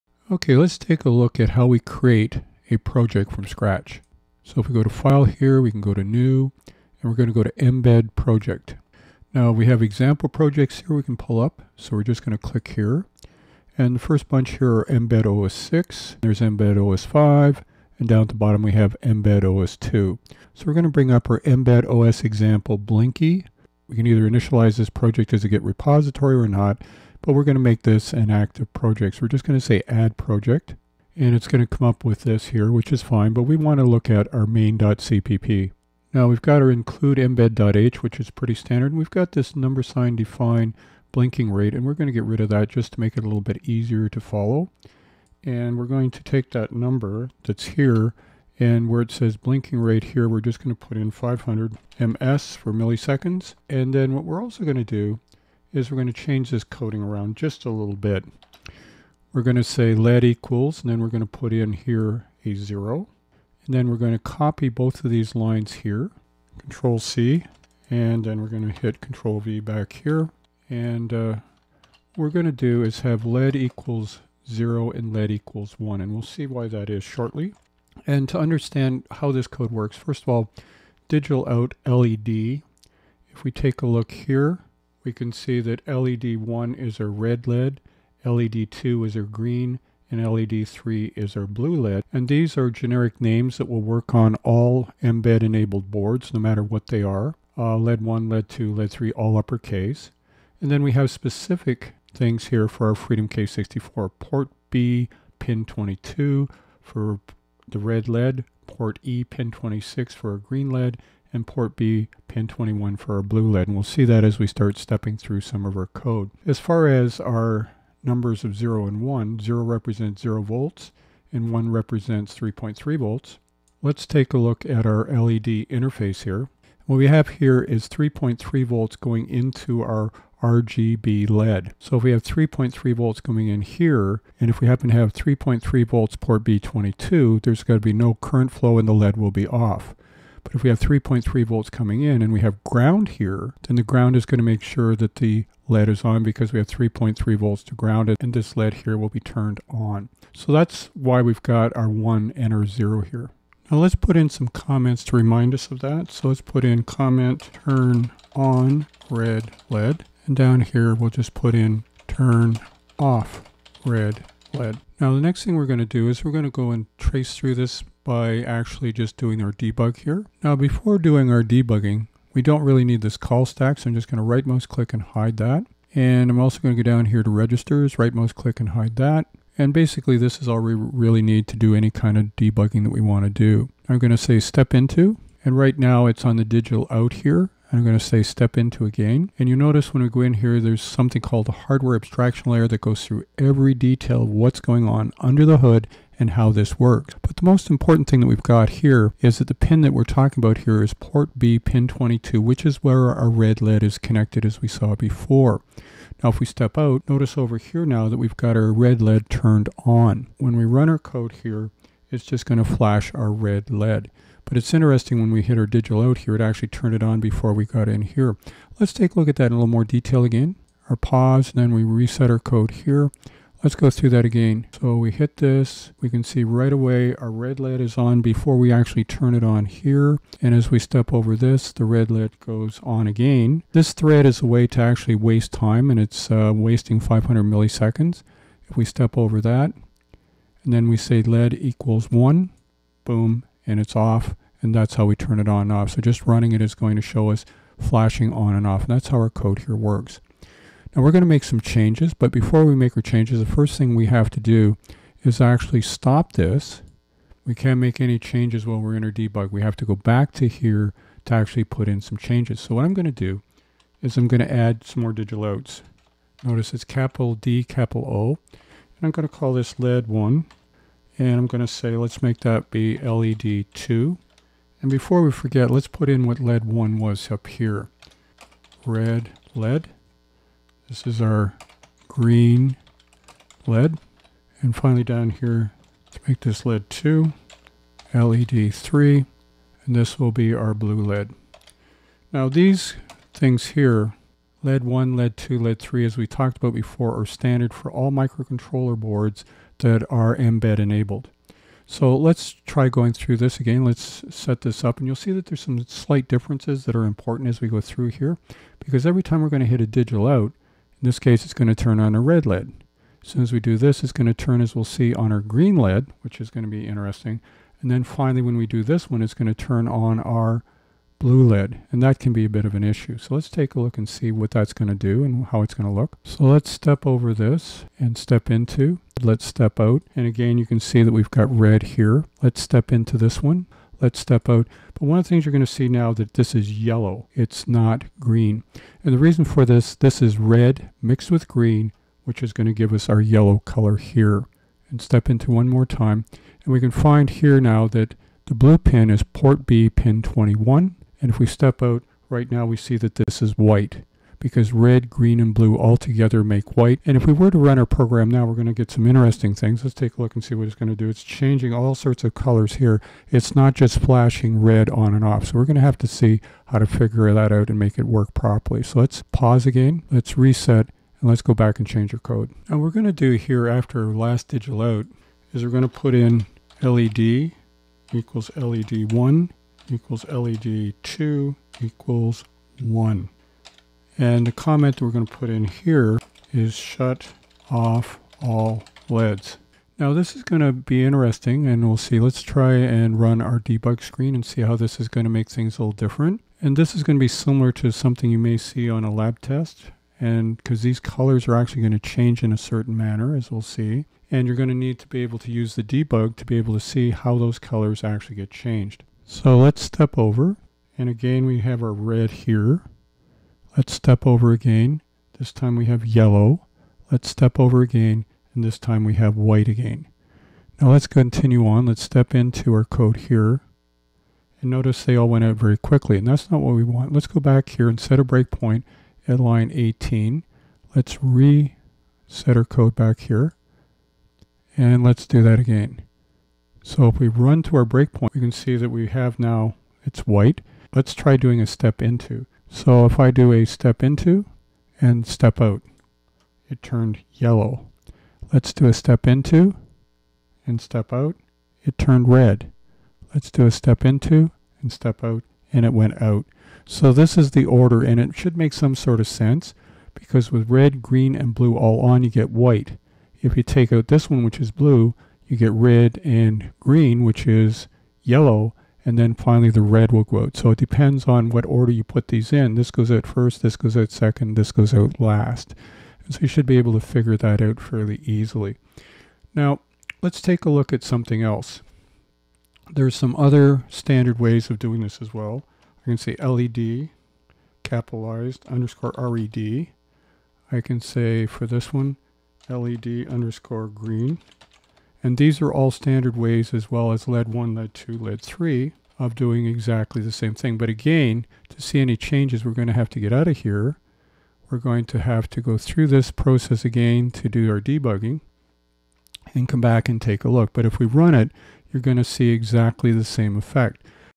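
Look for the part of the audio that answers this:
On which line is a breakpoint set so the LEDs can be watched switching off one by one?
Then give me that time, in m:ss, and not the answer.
7:09.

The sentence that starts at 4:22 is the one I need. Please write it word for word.
So what I'm going to do is I'm going to add some more digital outs.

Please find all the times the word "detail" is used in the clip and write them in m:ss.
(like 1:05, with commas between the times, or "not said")
3:13, 3:39.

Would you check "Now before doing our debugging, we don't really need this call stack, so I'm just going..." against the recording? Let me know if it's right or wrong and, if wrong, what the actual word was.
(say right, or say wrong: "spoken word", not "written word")
right.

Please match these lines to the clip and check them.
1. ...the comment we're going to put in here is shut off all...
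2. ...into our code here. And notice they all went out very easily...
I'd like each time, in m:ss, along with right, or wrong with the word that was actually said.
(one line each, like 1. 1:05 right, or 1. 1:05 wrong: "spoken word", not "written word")
1. 6:24 right
2. 7:02 wrong: "quickly", not "easily".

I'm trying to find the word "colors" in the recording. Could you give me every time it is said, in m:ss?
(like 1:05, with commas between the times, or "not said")
5:43, 6:02, 6:40, 6:47.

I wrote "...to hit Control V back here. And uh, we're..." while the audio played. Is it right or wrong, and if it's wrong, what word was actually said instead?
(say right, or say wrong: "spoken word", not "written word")
right.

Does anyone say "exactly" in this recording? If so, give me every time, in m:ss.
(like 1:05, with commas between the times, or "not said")
8:19, 8:32.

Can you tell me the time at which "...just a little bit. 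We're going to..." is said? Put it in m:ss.
0:57.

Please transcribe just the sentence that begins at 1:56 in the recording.
As far as our numbers of 0 and 1, 0 represents 0 volts and 1 represents 3.3 volts.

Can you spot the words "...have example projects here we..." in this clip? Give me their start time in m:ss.
0:09.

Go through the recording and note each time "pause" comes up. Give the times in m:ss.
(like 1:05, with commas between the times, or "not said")
3:40, 6:09.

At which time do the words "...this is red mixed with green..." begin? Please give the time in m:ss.
5:39.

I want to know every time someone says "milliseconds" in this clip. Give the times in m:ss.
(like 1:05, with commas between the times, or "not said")
0:52, 3:57.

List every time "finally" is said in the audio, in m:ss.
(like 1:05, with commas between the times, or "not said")
4:44, 5:18, 7:49.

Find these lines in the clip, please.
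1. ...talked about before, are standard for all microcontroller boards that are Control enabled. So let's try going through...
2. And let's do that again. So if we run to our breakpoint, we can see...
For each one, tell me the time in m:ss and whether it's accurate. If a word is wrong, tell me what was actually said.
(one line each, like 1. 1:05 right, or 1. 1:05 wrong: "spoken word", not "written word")
1. 4:56 wrong: "Mbed", not "Control"
2. 7:14 right.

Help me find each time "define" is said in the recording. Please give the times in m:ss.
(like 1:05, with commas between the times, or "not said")
0:40.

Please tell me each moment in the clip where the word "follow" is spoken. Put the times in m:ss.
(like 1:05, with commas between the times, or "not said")
0:44.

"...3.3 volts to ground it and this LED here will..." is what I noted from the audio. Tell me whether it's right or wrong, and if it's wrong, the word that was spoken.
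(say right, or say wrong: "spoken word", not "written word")
right.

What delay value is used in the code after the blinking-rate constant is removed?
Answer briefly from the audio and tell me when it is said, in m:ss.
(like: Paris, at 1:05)
500 ms, at 0:51.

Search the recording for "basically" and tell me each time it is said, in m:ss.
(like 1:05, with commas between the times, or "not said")
2:59.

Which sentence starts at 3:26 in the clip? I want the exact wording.
Now if we step out, notice over here now that we've got our red LED turned on.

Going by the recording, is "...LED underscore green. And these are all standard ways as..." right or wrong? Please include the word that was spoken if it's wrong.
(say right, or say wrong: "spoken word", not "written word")
right.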